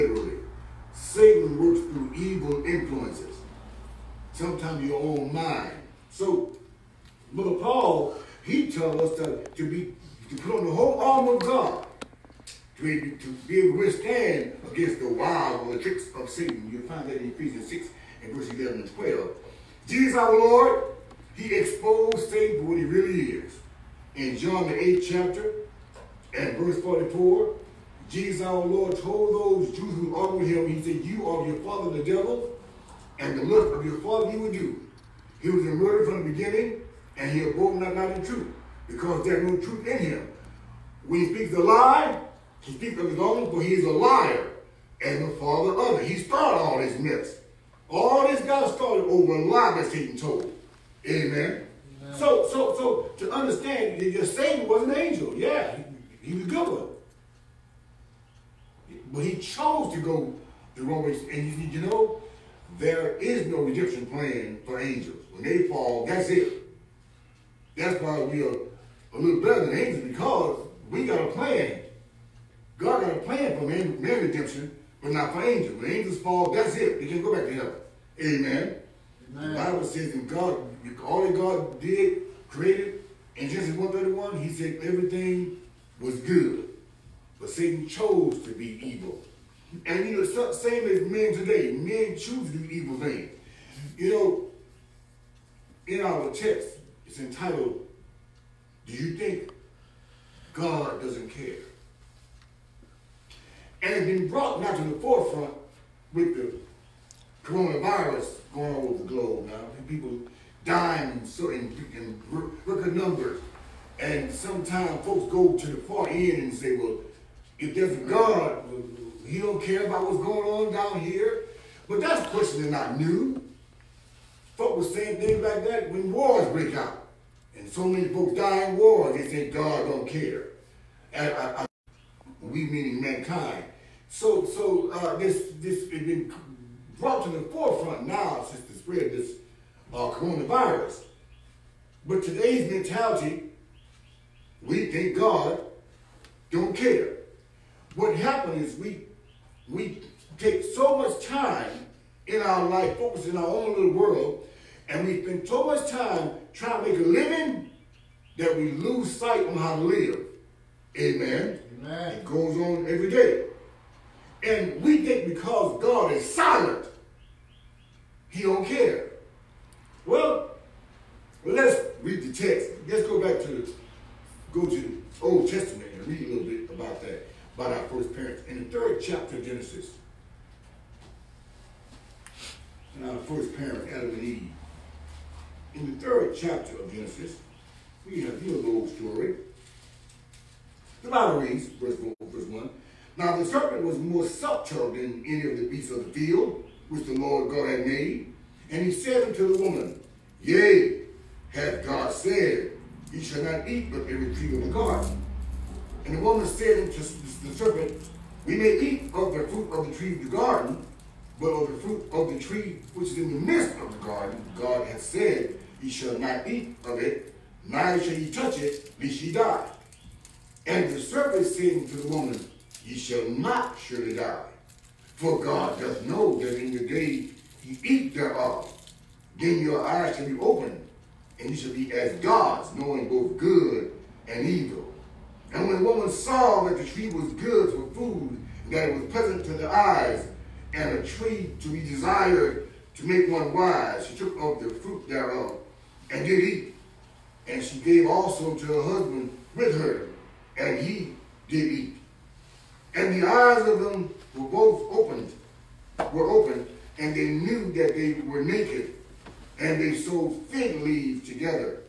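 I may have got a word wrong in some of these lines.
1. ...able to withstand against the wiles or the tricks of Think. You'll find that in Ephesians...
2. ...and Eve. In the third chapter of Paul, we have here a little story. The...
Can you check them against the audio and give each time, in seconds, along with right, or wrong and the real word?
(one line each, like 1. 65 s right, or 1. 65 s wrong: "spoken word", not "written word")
1. 13 s wrong: "Satan", not "Think"
2. 184 s wrong: "Genesis", not "Paul".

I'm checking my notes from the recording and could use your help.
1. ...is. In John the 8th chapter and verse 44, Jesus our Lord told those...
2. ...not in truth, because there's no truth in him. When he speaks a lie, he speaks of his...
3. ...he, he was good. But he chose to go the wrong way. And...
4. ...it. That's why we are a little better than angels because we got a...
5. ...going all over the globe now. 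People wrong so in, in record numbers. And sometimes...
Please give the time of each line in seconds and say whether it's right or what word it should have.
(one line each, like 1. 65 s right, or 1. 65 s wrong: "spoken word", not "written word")
1. 23 s right
2. 37 s right
3. 56 s right
4. 66 s right
5. 108 s wrong: "dying", not "wrong".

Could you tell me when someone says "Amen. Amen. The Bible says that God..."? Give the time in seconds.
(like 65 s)
78 s.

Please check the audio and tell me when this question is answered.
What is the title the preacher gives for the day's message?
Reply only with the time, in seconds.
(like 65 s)
98 s.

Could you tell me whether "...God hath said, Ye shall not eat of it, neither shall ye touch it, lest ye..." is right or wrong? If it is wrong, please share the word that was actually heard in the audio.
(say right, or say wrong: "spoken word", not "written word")
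right.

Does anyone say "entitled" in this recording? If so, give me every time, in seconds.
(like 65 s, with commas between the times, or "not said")
97 s.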